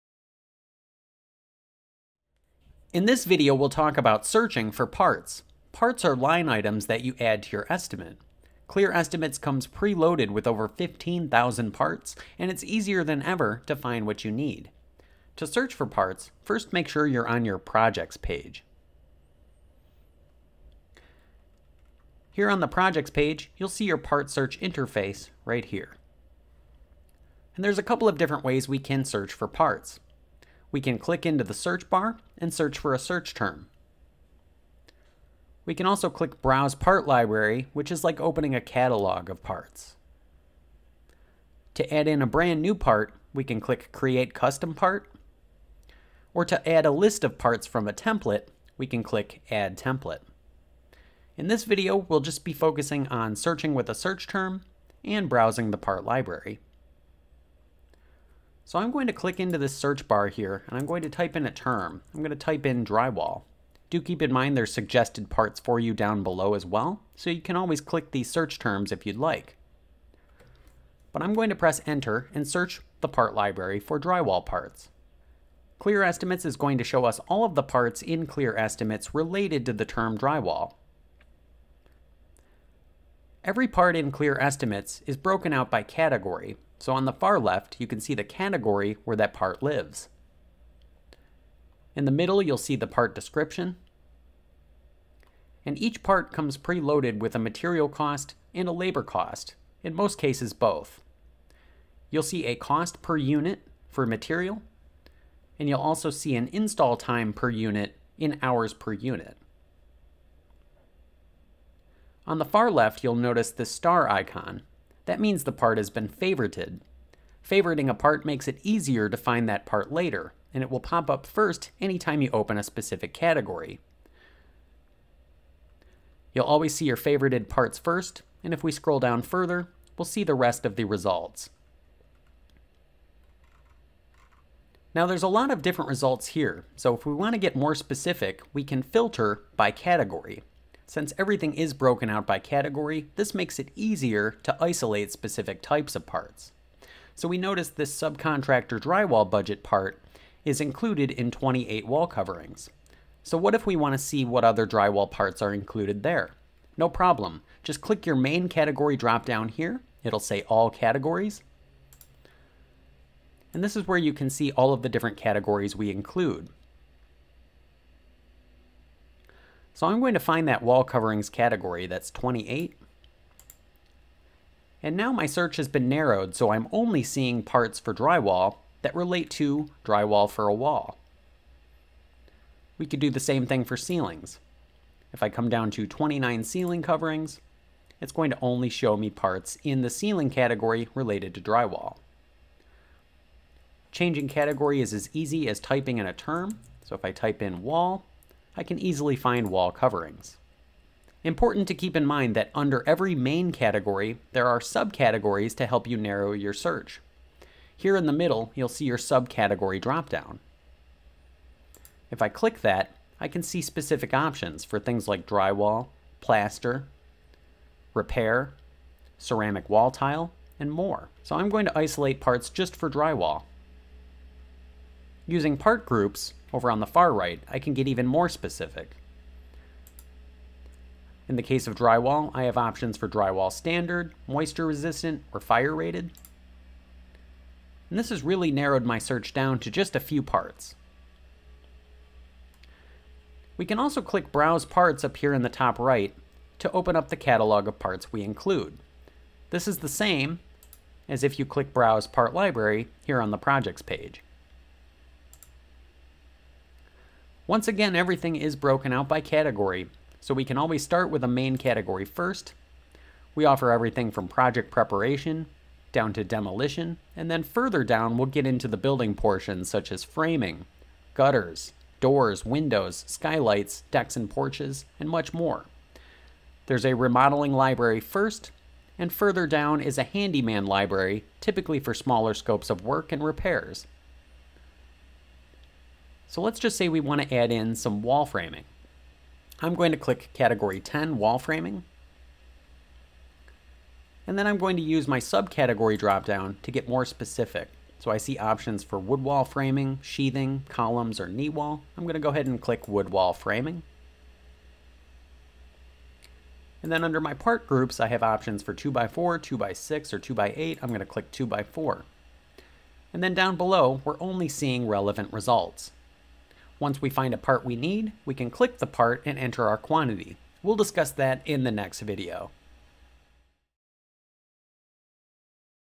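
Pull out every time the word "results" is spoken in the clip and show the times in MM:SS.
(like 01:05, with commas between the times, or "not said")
02:10, 02:15, 05:15.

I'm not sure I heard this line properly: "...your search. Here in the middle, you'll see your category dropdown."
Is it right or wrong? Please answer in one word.
wrong.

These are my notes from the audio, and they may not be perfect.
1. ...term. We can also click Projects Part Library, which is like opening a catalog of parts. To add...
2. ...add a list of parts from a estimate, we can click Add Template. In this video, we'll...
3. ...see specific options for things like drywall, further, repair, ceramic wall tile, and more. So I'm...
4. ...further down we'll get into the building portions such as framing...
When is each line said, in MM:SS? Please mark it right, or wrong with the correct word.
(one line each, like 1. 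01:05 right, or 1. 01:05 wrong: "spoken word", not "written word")
1. 00:33 wrong: "Browse", not "Projects"
2. 00:46 wrong: "template", not "estimate"
3. 03:33 wrong: "plaster", not "further"
4. 04:27 right.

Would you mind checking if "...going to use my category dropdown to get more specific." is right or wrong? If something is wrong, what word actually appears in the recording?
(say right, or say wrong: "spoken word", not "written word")
wrong: "subcategory", not "category".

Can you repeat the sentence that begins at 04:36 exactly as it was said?
There's a remodeling library first, and further down is a handyman library, typically for smaller scopes of work and repairs.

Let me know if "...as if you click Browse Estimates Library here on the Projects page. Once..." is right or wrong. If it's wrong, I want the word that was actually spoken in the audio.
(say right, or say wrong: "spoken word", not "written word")
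wrong: "Part", not "Estimates".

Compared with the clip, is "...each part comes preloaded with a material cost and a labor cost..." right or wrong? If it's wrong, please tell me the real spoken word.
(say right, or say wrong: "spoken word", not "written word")
right.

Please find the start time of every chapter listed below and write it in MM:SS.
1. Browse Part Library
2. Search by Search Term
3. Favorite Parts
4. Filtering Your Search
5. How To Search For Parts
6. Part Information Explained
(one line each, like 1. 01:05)
1. 04:03
2. 00:58
3. 01:52
4. 02:14
5. 00:15
6. 01:22.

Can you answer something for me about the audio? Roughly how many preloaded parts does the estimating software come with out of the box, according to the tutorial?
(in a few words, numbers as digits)
15,000.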